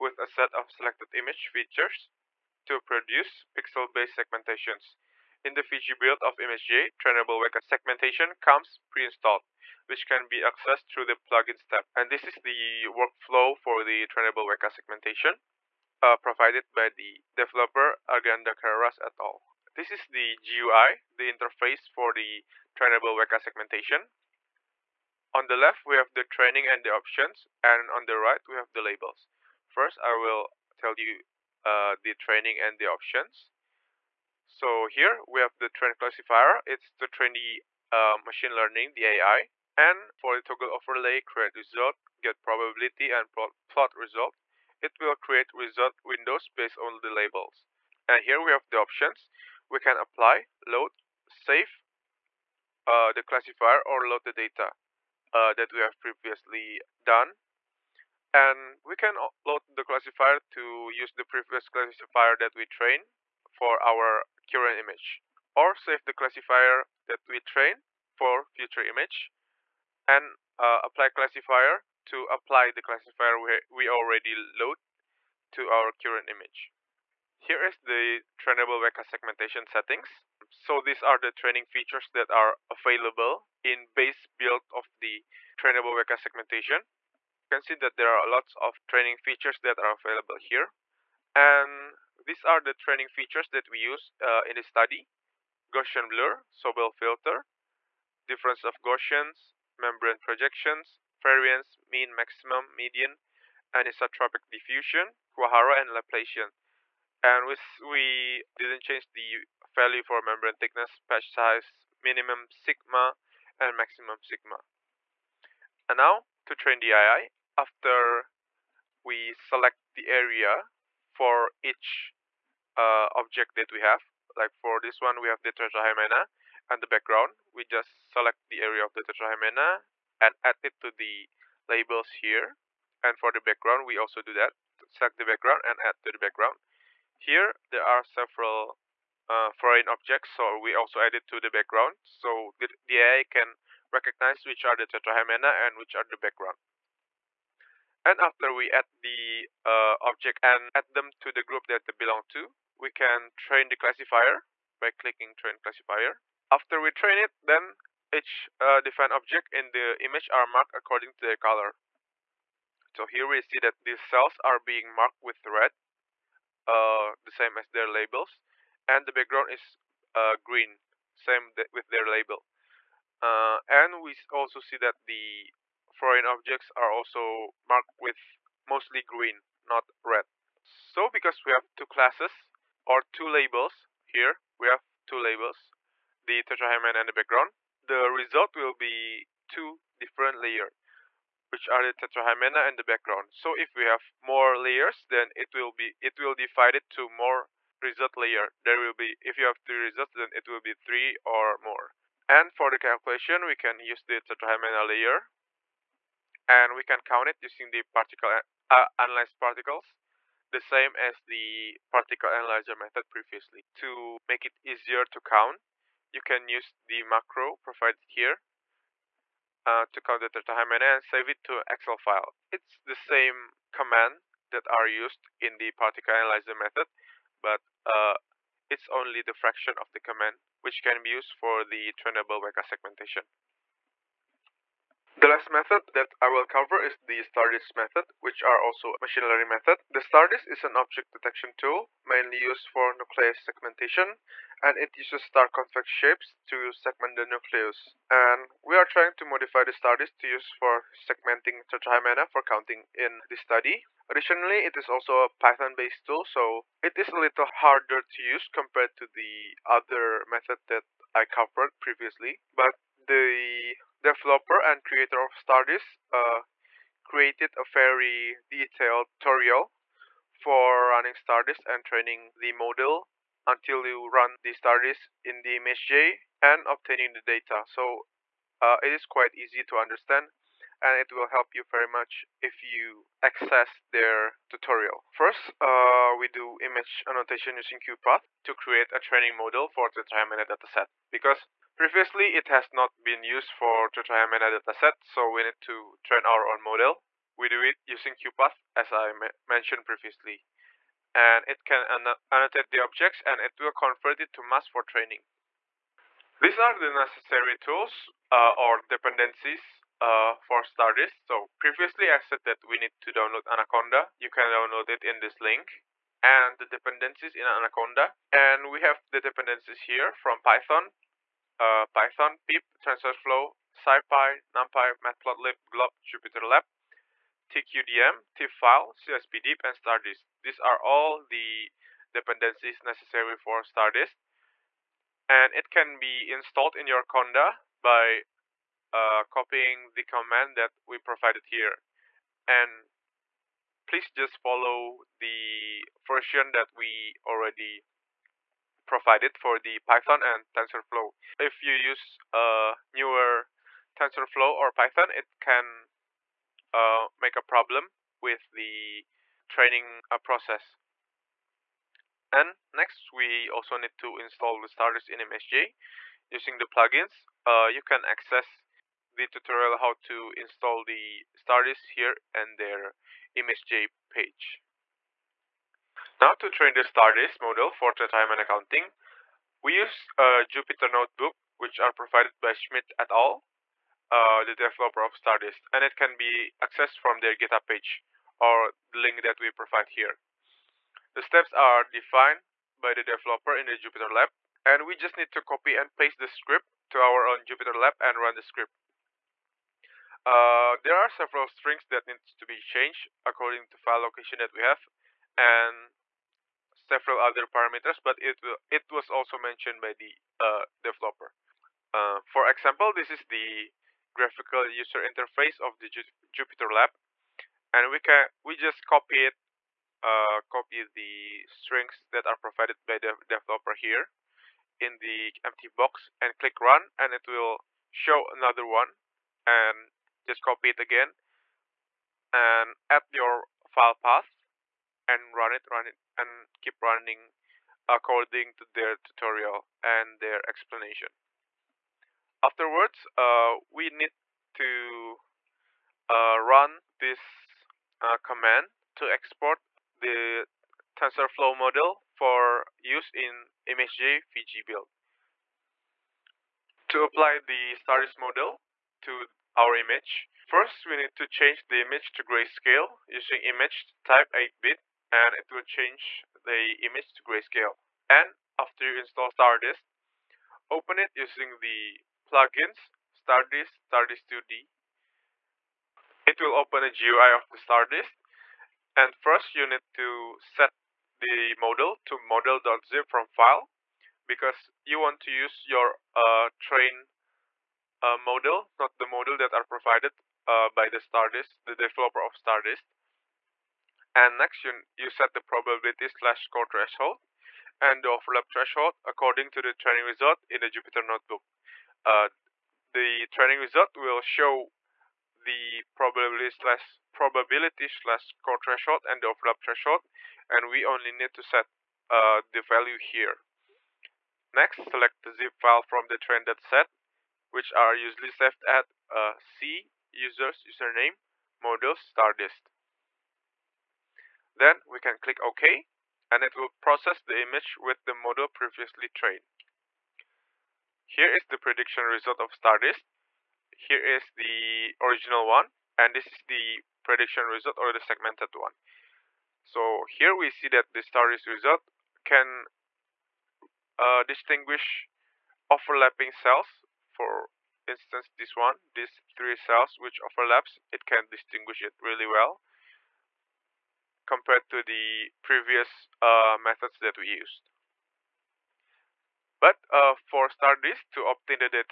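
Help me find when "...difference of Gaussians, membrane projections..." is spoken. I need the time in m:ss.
1:38.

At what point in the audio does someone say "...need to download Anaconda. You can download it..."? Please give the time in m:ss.
5:12.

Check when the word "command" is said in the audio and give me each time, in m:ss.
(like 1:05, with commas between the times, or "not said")
3:43, 3:49, 5:40, 7:28.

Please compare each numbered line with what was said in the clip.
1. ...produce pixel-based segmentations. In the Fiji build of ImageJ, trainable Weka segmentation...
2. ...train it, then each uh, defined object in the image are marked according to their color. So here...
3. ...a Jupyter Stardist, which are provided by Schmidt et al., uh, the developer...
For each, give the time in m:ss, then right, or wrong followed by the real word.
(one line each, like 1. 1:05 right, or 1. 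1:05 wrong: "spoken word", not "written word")
1. 0:02 right
2. 2:36 right
3. 6:20 wrong: "Notebook", not "Stardist".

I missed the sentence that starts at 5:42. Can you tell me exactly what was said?
And please just follow the version that we already provided for the Python and TensorFlow.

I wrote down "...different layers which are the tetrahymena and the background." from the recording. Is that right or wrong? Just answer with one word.
right.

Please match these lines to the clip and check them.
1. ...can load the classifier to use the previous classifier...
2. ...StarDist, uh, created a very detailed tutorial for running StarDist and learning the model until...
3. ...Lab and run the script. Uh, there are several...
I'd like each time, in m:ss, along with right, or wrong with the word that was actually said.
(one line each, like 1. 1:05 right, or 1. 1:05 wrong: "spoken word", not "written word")
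1. 0:58 right
2. 4:25 wrong: "training", not "learning"
3. 6:37 right.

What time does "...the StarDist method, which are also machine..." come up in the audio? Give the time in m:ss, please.
3:56.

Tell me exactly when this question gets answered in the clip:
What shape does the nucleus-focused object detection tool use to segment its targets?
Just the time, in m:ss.
4:05.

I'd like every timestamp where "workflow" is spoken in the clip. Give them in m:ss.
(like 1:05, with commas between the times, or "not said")
0:12.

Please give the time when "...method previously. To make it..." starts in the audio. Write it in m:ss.
3:32.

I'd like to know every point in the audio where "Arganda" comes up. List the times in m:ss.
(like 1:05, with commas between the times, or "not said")
0:18.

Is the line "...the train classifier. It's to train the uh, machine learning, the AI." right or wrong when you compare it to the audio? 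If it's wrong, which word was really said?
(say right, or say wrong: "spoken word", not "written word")
right.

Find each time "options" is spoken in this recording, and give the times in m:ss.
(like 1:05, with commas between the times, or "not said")
0:26, 0:32, 0:48.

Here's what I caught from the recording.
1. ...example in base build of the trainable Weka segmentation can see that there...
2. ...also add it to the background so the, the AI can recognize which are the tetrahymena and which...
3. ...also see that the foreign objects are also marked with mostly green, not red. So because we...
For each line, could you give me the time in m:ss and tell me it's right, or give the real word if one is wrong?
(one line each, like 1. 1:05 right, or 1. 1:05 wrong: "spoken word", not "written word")
1. 1:22 wrong: "available", not "example"
2. 2:20 right
3. 2:54 right.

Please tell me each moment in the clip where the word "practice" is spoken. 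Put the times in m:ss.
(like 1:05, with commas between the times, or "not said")
not said.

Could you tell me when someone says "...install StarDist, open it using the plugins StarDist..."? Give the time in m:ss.
7:48.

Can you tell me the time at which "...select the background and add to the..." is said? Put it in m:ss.
2:14.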